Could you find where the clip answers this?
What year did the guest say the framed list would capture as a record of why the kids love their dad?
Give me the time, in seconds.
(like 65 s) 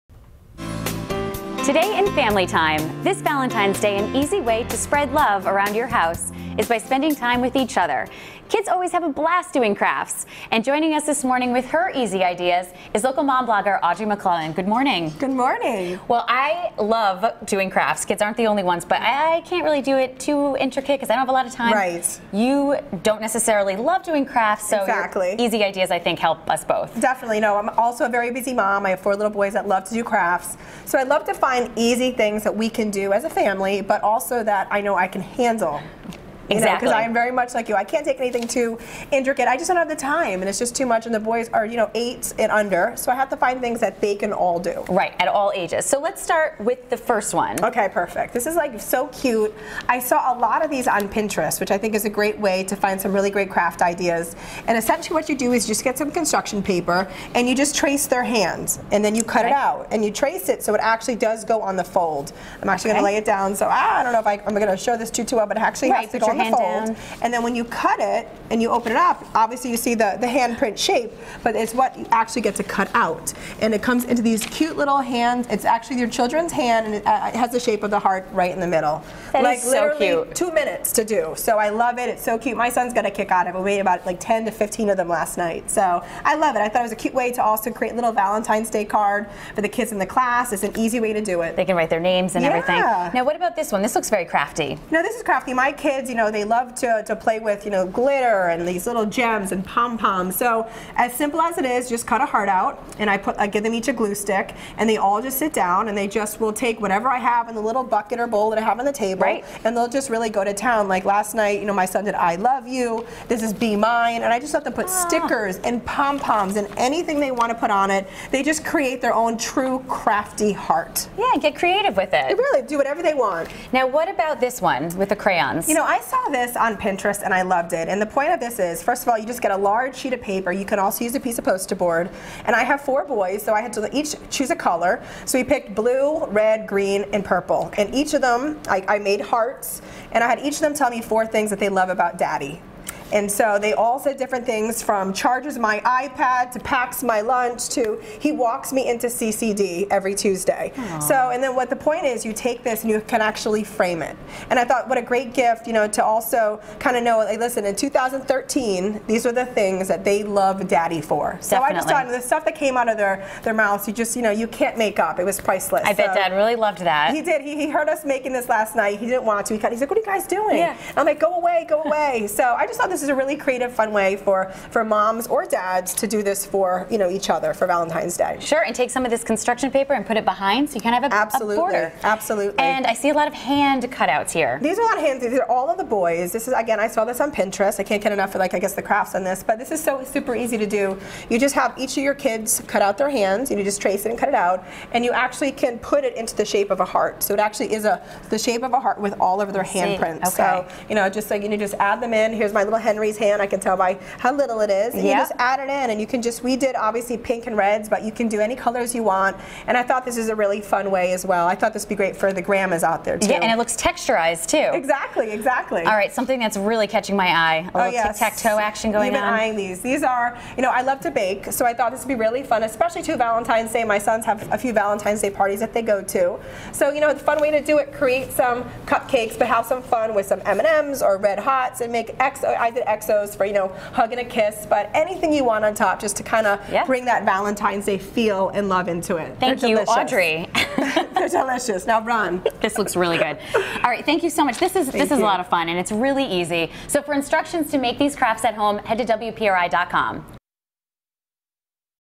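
157 s.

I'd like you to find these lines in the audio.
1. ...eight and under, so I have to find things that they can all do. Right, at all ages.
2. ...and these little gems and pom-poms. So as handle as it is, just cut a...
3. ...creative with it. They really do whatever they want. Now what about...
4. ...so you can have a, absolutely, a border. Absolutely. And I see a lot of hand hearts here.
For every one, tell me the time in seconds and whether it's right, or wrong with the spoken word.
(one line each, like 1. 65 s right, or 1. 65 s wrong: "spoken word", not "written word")
1. 41 s right
2. 98 s wrong: "simple", not "handle"
3. 121 s right
4. 180 s wrong: "cutouts", not "hearts".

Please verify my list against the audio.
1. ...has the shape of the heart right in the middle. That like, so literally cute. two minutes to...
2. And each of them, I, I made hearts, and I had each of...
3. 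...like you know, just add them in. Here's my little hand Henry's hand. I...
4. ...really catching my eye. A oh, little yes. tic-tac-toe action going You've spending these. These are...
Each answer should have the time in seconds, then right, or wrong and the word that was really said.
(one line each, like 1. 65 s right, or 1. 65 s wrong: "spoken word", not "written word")
1. 77 s right
2. 137 s right
3. 201 s right
4. 216 s wrong: "eyeing", not "spending".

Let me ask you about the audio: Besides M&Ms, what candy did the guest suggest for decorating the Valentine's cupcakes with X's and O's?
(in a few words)
Red Hots.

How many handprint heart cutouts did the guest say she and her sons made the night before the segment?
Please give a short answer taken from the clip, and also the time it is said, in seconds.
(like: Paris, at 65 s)
10 to 15, at 84 s.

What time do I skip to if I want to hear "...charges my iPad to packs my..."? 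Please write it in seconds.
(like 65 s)
145 s.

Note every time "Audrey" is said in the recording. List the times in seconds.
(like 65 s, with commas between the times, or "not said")
13 s, 240 s.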